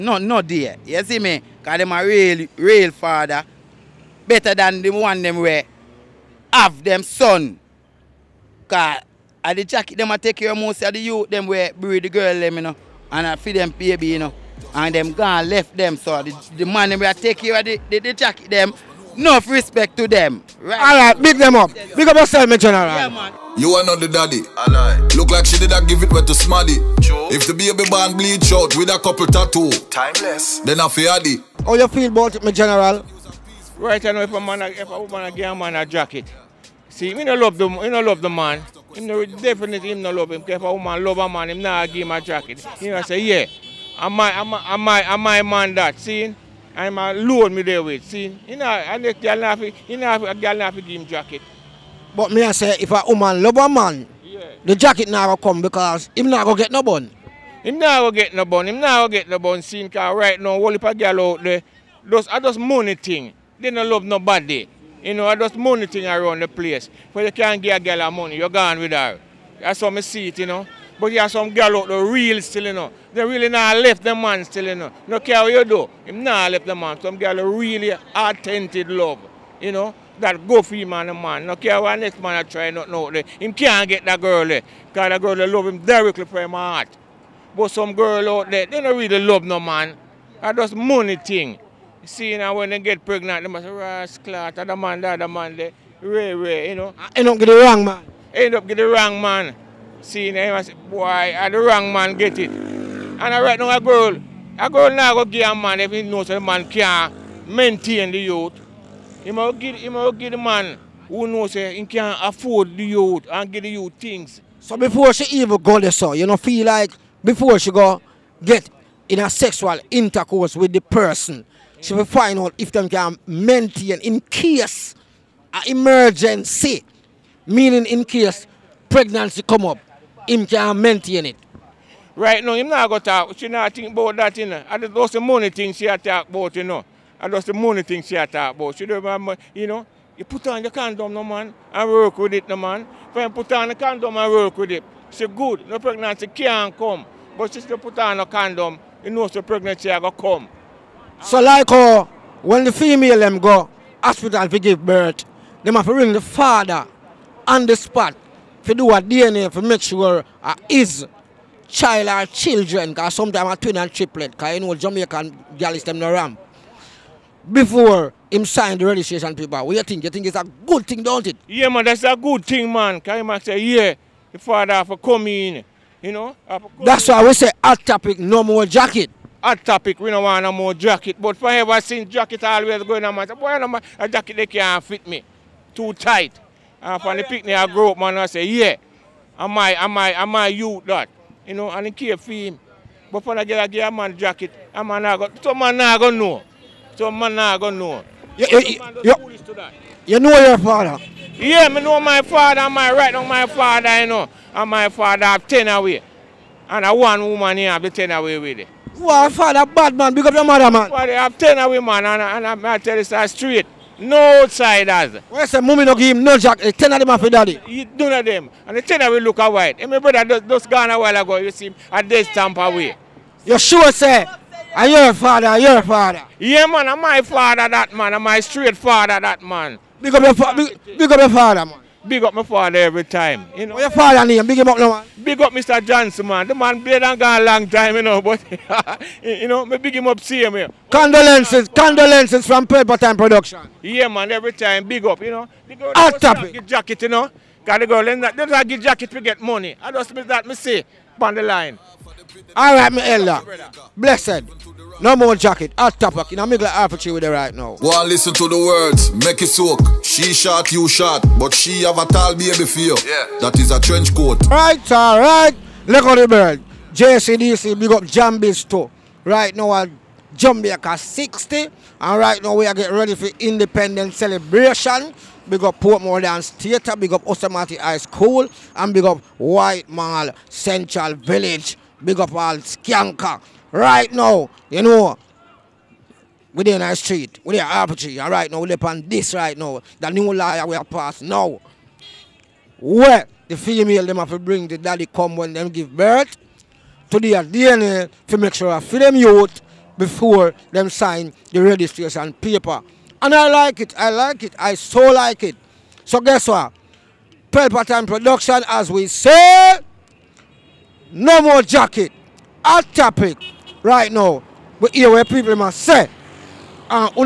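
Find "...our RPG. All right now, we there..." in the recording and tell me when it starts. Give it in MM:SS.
04:47.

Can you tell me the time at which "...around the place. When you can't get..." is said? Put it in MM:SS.
01:06.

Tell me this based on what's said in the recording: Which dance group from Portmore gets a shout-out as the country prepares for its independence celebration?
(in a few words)
Portmore Dance Theatre.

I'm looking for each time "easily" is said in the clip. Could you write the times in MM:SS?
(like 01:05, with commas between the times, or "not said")
not said.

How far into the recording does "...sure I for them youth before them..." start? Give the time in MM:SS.
04:58.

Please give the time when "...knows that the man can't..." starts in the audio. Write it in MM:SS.
01:46.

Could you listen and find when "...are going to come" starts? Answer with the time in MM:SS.
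02:29.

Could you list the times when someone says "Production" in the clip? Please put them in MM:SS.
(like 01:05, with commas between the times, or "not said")
04:03, 05:08.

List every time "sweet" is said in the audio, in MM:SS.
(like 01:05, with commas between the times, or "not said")
not said.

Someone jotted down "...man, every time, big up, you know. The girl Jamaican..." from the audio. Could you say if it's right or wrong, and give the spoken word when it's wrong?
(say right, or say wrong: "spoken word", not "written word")
wrong: "Hot", not "Jamaican".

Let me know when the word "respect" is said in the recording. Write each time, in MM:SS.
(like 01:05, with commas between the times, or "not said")
00:19.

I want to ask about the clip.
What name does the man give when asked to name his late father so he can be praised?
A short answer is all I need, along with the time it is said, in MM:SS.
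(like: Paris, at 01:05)
Mr. Johnson, at 03:55.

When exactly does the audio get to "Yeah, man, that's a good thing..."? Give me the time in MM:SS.
02:51.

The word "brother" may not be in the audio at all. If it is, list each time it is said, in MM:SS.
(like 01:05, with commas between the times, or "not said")
03:39.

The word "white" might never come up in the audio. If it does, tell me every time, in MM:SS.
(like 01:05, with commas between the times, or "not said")
03:39, 04:39.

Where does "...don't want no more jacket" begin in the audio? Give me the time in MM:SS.
03:00.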